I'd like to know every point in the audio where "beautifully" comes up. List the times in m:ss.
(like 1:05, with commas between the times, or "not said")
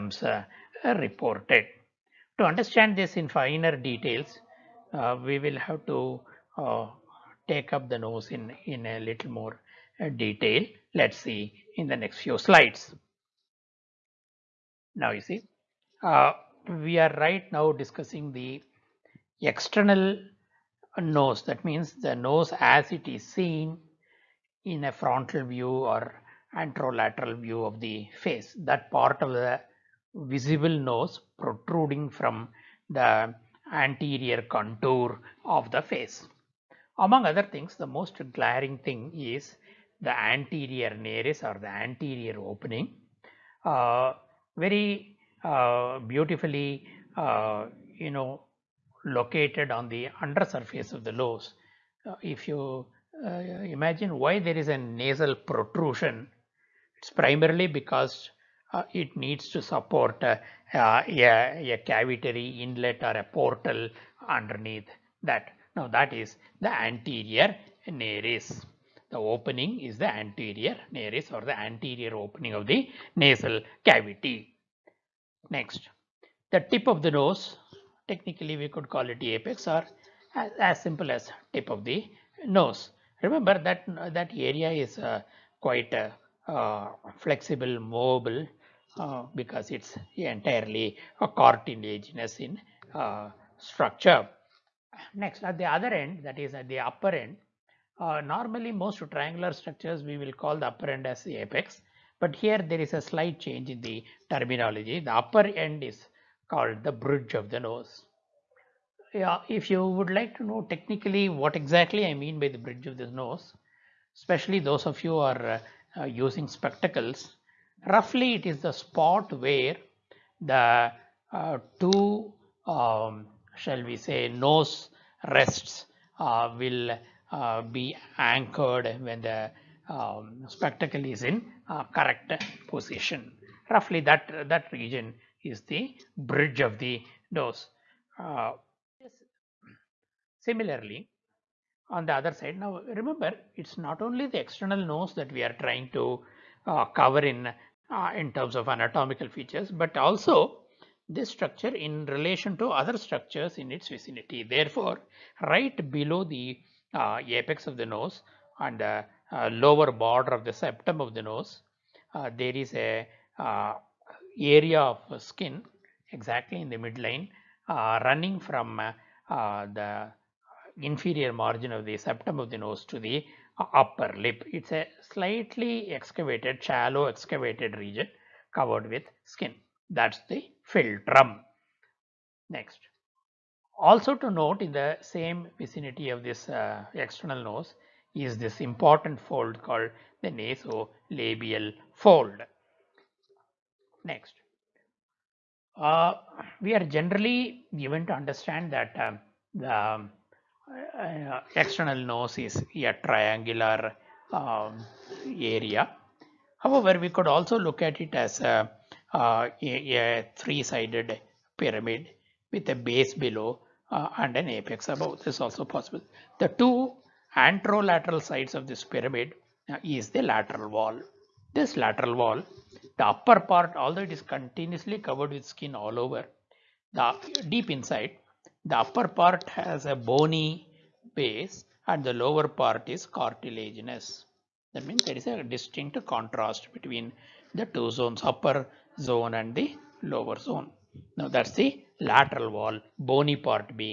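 0:46.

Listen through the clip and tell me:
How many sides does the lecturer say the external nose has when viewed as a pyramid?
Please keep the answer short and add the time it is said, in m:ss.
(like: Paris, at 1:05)
3, at 3:30.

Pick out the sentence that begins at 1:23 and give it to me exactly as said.
Remember that that area is uh, quite uh, uh, flexible, mobile uh, because it's entirely a cartilaginous in uh, structure.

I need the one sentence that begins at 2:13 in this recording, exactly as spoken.
Roughly that, that region is the bridge of the nose.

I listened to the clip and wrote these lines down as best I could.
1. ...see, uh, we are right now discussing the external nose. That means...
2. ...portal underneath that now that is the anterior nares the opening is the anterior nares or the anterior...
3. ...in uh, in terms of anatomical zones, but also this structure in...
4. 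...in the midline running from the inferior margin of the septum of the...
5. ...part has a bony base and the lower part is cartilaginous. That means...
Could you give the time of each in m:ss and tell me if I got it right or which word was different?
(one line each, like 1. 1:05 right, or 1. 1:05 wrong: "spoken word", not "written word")
1. 0:15 right
2. 1:03 right
3. 2:27 wrong: "features", not "zones"
4. 2:46 right
5. 3:49 right.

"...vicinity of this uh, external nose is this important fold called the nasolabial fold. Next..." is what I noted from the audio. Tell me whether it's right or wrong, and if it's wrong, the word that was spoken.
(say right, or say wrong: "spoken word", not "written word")
right.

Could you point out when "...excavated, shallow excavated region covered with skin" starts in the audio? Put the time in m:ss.
2:55.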